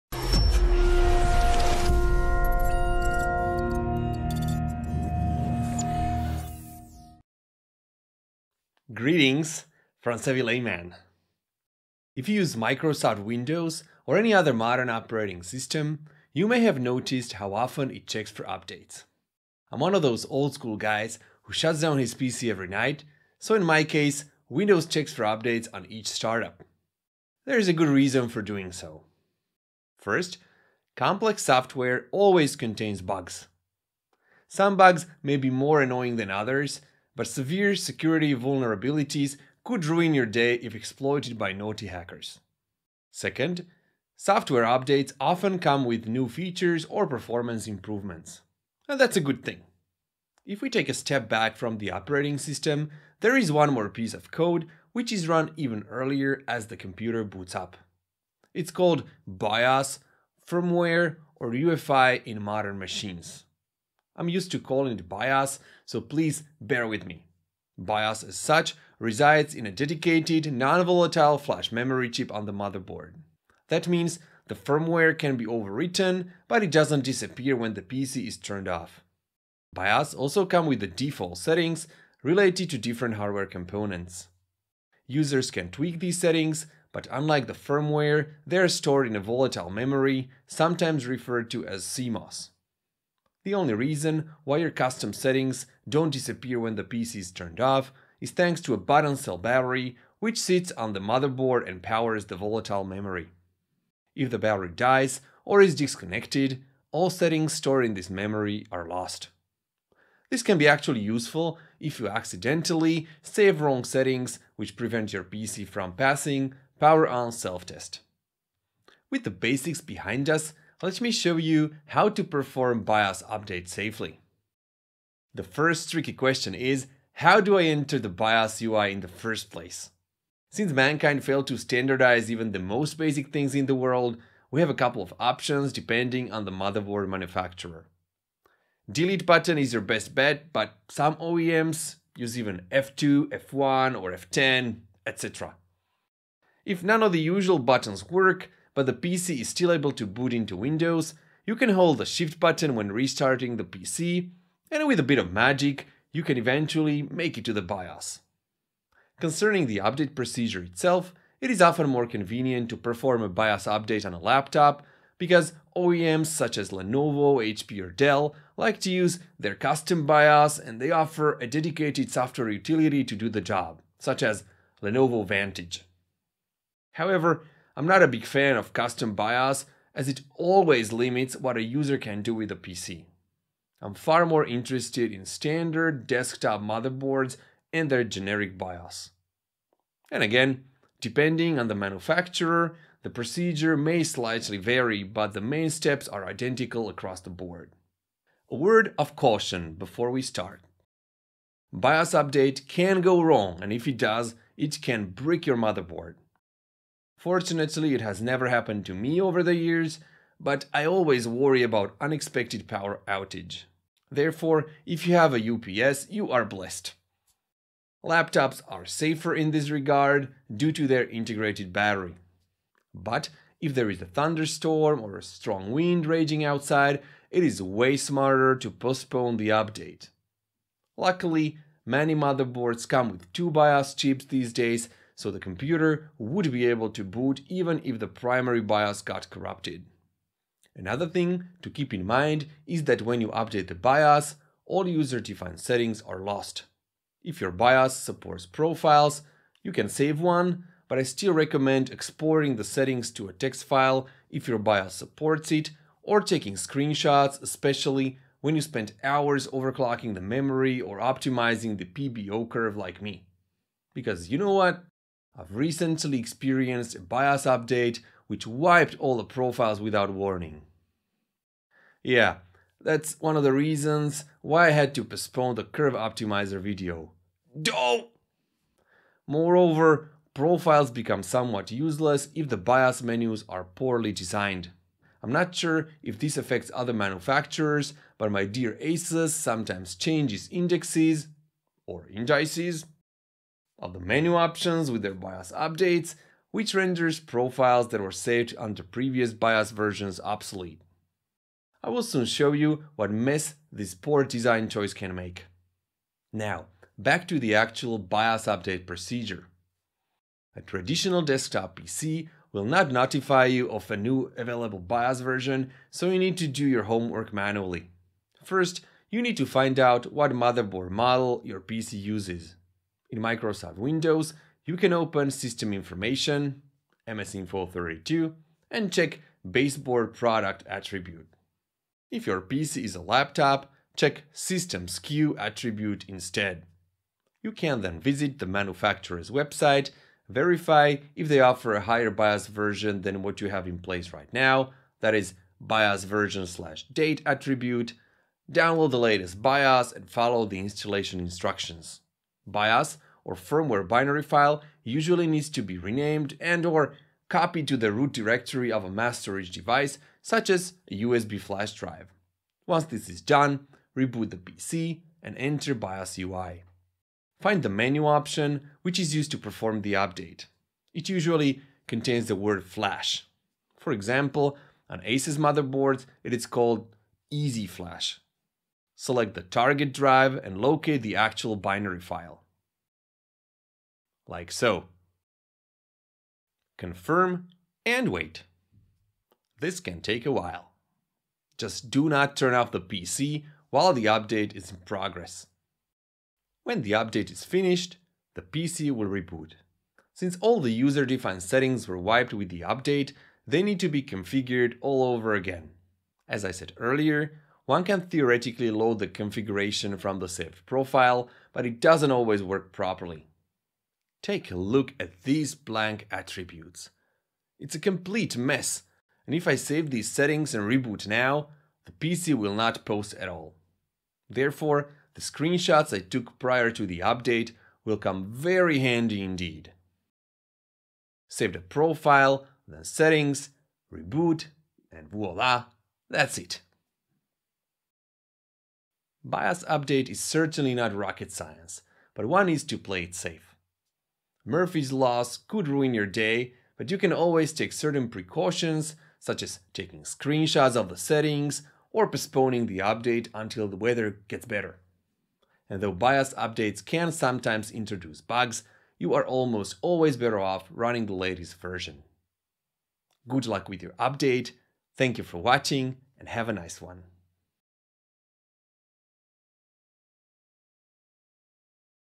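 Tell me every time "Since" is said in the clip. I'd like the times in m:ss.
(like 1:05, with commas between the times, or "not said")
2:10, 6:40.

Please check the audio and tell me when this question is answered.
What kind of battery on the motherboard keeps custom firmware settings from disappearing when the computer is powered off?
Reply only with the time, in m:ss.
1:38.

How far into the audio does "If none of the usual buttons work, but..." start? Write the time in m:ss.
2:26.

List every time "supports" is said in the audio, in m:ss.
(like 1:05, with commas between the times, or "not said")
4:07, 4:14.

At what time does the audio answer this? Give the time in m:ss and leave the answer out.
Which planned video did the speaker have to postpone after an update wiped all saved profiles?
4:35.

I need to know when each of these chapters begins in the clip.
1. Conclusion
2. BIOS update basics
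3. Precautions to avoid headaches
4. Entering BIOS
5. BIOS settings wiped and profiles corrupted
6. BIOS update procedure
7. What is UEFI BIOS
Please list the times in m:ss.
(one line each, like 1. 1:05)
1. 7:19
2. 2:39
3. 3:18
4. 1:58
5. 6:40
6. 5:06
7. 0:50.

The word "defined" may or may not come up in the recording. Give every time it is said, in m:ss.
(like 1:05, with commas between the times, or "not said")
4:04, 6:40.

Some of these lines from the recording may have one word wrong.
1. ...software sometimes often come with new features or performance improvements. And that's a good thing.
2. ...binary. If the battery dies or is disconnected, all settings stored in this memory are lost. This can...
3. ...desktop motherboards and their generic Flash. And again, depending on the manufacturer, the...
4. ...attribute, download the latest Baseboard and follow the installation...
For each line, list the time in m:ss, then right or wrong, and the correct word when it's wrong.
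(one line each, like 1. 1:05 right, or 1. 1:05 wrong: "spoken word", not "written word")
1. 0:44 wrong: "updates", not "sometimes"
2. 1:42 wrong: "memory", not "binary"
3. 3:06 wrong: "BIOS", not "Flash"
4. 5:47 wrong: "BIOS", not "Baseboard".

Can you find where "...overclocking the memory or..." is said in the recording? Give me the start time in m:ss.
4:19.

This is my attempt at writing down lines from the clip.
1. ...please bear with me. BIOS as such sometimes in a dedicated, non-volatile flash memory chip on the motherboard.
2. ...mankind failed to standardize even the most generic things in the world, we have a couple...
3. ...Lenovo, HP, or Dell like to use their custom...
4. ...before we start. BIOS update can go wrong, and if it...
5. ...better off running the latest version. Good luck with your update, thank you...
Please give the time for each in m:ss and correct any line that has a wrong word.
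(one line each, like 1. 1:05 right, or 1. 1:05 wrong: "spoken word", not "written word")
1. 1:05 wrong: "resides", not "sometimes"
2. 2:10 wrong: "basic", not "generic"
3. 2:46 right
4. 3:19 right
5. 7:40 right.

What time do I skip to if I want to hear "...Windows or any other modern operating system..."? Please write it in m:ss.
0:13.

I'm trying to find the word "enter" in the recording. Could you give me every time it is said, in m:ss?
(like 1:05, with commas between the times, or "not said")
2:07, 6:05.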